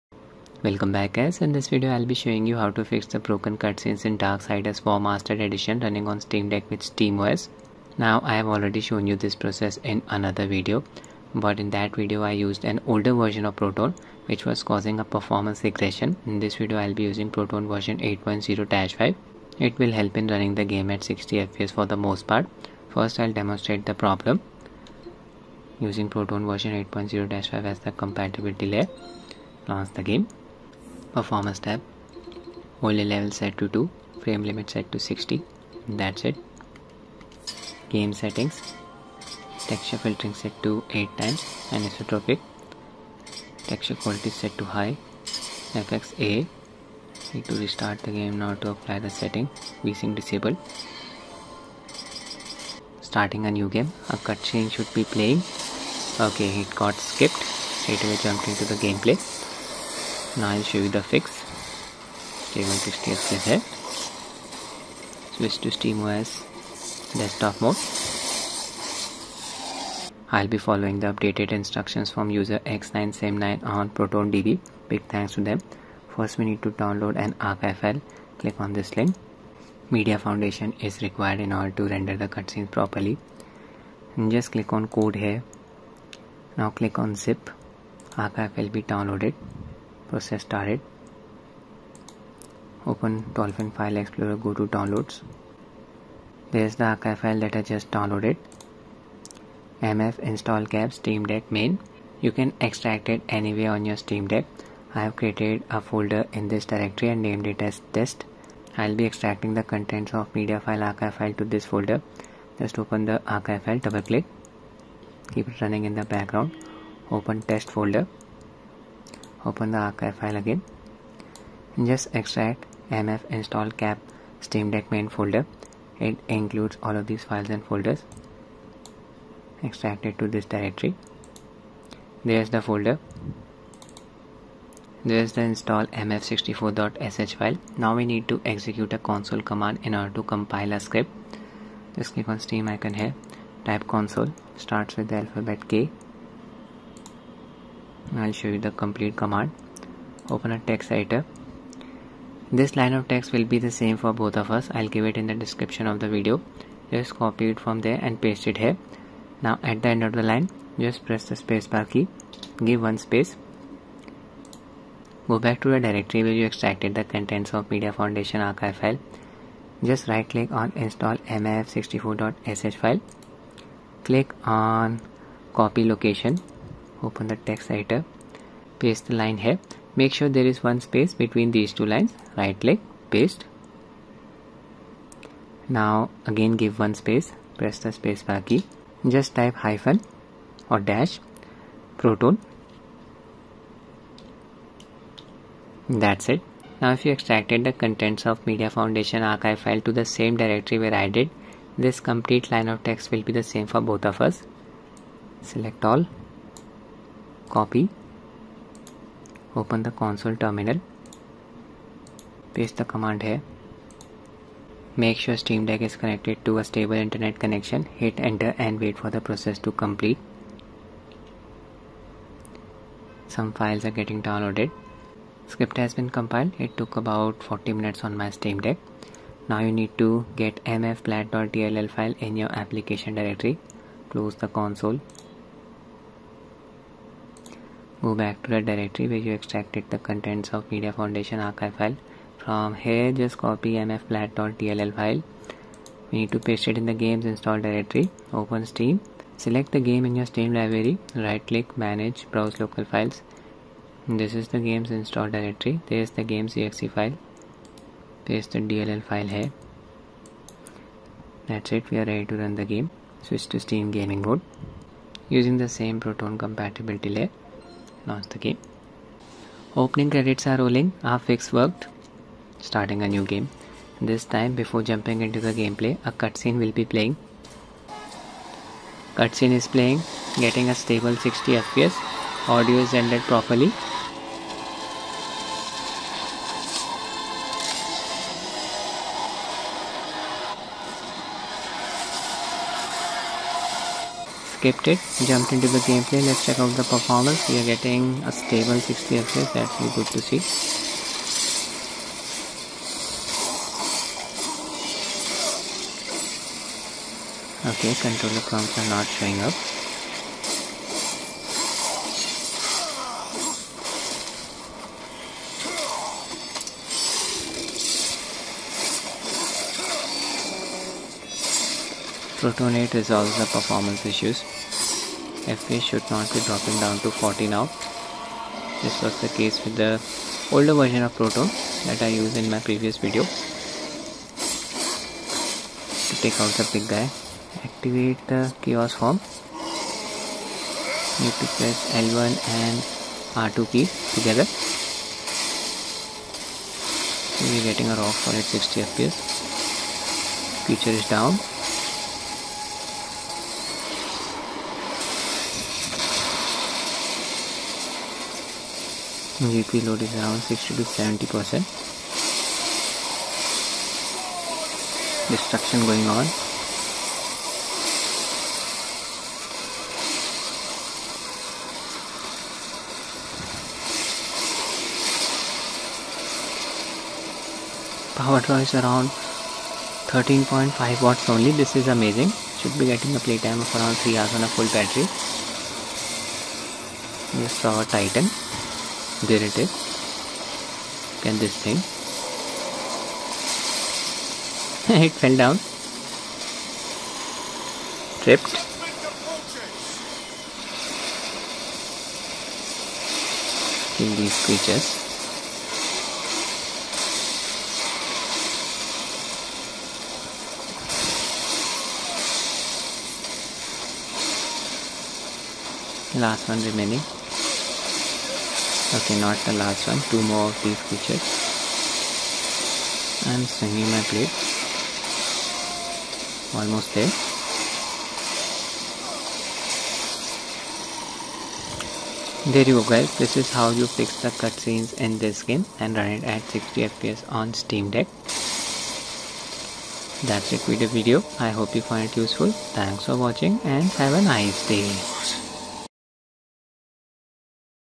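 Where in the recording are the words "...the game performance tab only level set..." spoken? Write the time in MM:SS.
00:29.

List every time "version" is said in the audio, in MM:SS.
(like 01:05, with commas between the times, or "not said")
00:13, 00:17, 00:26, 05:30.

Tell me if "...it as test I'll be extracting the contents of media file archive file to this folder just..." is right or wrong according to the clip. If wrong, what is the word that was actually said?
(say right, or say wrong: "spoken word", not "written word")
right.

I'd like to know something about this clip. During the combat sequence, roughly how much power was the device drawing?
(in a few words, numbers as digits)
13.5 watts.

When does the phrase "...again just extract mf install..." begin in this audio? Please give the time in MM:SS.
02:00.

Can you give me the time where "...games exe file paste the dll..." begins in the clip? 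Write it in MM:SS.
04:16.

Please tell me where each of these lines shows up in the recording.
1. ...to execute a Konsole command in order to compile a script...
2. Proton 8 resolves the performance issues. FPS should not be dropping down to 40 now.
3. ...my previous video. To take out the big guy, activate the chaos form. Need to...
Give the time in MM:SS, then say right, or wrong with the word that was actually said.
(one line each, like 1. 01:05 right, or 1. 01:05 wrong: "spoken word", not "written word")
1. 02:18 right
2. 05:22 right
3. 05:32 right.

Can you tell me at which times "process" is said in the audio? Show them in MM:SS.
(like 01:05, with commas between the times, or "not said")
00:09, 01:30, 03:39.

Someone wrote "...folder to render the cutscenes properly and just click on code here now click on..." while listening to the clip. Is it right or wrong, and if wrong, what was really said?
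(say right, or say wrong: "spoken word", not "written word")
wrong: "order", not "folder".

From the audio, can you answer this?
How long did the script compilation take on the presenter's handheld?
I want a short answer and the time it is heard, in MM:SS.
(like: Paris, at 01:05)
40 minutes, at 03:47.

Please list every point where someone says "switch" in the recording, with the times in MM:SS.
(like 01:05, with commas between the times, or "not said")
01:05, 04:23.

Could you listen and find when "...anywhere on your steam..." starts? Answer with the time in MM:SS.
01:43.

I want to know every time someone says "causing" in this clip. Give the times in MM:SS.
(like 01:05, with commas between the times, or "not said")
00:14.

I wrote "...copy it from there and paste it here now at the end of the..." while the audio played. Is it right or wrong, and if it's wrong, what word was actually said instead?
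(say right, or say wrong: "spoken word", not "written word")
right.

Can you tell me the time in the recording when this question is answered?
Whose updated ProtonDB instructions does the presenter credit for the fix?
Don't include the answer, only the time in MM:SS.
01:12.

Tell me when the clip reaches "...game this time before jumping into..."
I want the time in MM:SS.
04:33.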